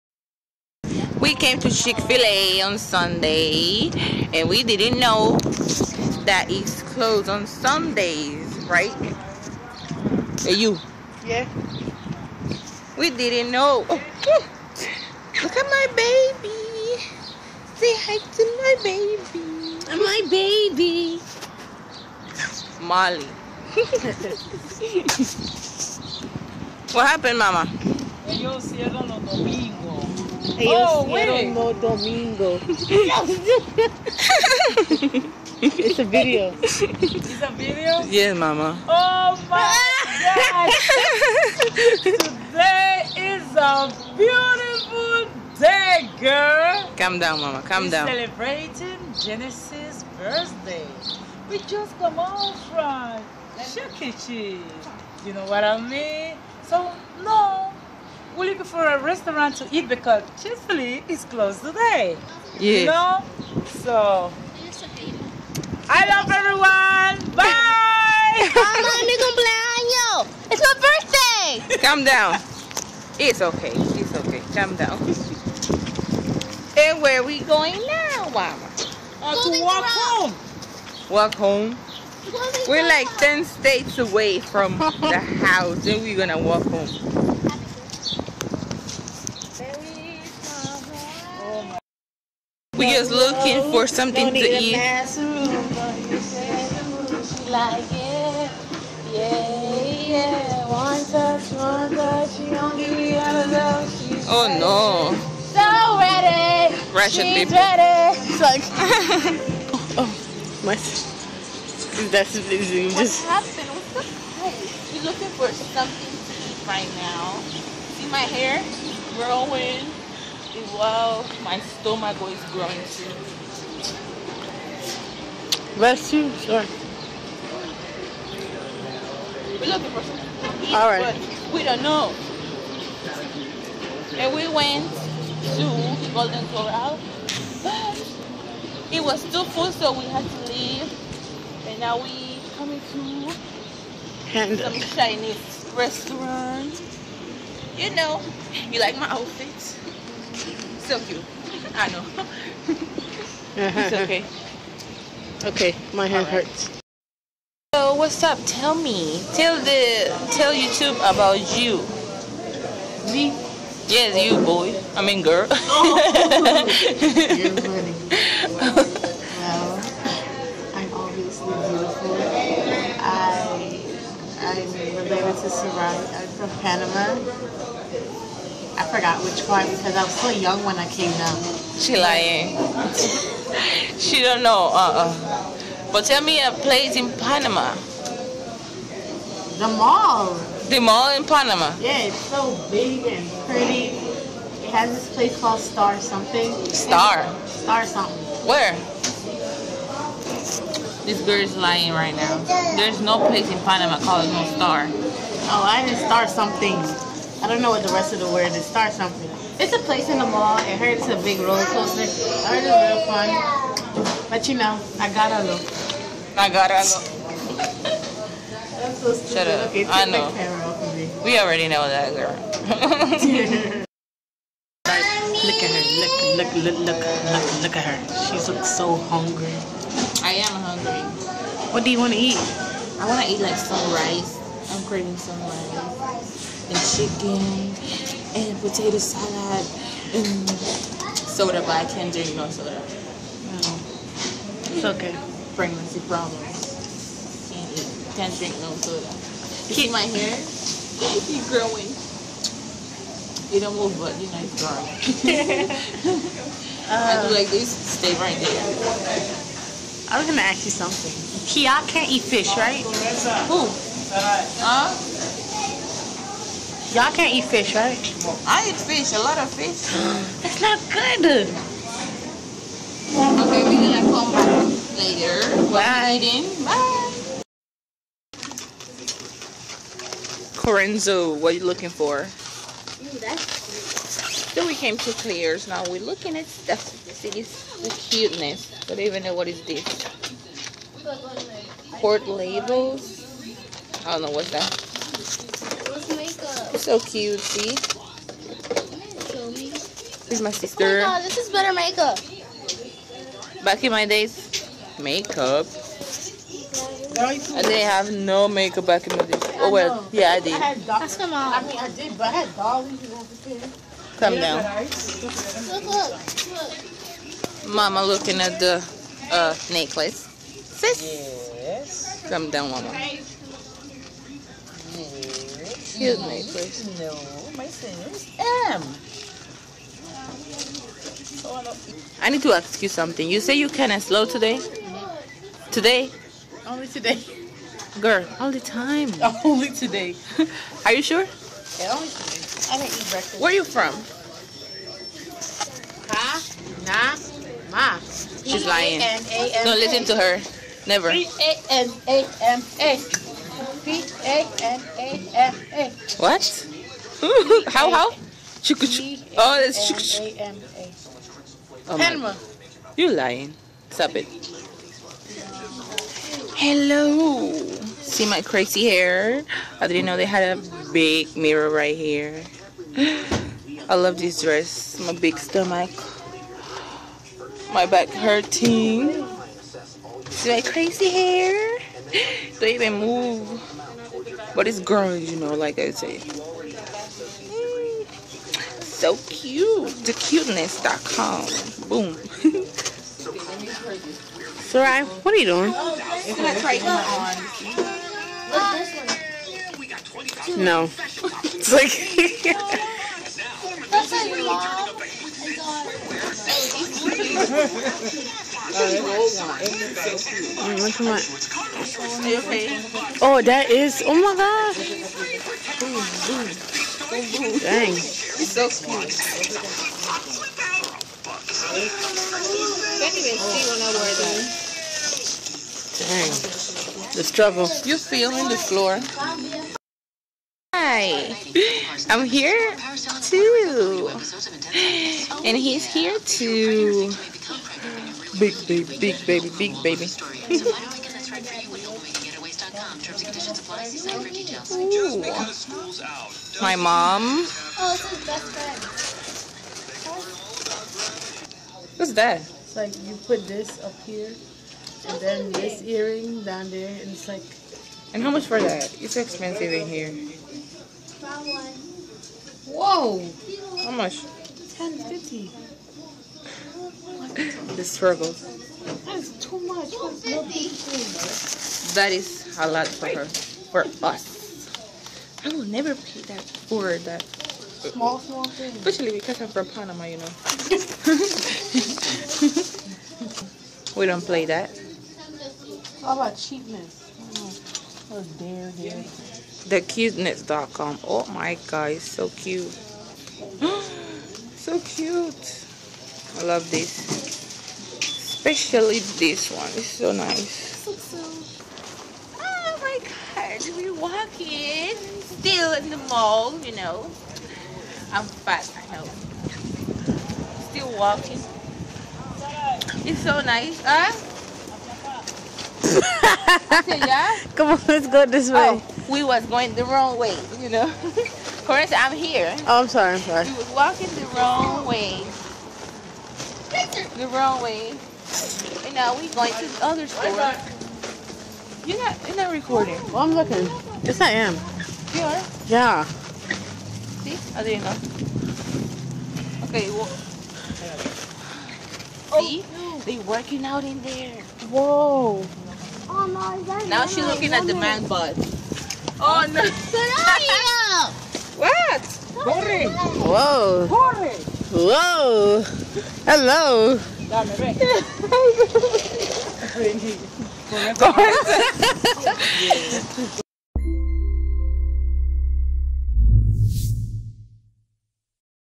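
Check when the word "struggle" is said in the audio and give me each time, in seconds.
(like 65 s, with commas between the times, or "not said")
427 s, 467 s.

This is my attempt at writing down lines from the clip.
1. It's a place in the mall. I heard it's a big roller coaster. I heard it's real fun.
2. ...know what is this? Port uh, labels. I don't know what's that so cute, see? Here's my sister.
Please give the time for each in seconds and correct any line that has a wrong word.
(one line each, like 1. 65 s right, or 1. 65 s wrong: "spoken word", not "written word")
1. 209 s right
2. 289 s right.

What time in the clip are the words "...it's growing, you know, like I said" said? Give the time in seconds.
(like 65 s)
384 s.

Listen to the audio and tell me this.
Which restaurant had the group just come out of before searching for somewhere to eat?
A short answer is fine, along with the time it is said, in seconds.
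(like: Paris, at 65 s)
Shukichi, at 53 s.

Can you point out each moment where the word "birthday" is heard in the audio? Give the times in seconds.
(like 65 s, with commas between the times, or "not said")
50 s, 70 s.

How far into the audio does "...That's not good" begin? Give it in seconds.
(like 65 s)
270 s.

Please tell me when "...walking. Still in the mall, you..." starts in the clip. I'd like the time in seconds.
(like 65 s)
503 s.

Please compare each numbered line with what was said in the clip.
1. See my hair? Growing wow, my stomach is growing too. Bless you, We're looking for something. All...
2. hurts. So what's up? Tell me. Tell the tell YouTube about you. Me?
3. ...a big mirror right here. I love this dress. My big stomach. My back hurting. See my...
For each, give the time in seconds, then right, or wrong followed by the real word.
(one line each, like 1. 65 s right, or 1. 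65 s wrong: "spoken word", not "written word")
1. 117 s right
2. 156 s right
3. 370 s right.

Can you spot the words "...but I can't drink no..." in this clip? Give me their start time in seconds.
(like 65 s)
241 s.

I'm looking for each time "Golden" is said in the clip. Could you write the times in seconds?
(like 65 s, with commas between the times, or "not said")
136 s.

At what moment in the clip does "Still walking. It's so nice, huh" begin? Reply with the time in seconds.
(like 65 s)
510 s.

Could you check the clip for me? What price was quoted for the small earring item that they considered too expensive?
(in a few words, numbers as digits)
$10.50.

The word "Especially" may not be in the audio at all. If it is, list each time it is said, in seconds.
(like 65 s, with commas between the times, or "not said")
478 s, 498 s.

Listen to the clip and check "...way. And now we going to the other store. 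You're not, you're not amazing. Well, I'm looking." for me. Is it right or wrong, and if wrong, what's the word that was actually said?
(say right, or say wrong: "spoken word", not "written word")
wrong: "recording", not "amazing".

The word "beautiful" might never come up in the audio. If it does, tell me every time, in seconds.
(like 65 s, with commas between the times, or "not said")
44 s, 171 s.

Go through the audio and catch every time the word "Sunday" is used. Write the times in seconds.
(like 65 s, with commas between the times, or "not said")
2 s, 7 s.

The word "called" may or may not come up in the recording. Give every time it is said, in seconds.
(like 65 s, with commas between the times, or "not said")
195 s, 203 s.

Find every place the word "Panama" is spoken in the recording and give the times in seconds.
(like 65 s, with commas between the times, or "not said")
176 s, 187 s, 191 s, 203 s, 479 s.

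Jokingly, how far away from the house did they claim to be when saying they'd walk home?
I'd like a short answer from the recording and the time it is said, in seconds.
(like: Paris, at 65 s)
10 states, at 83 s.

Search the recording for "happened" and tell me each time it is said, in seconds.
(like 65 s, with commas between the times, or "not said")
27 s, 113 s.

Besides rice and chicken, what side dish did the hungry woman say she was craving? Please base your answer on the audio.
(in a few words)
potato salad.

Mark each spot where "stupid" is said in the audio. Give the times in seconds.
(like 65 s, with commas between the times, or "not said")
219 s.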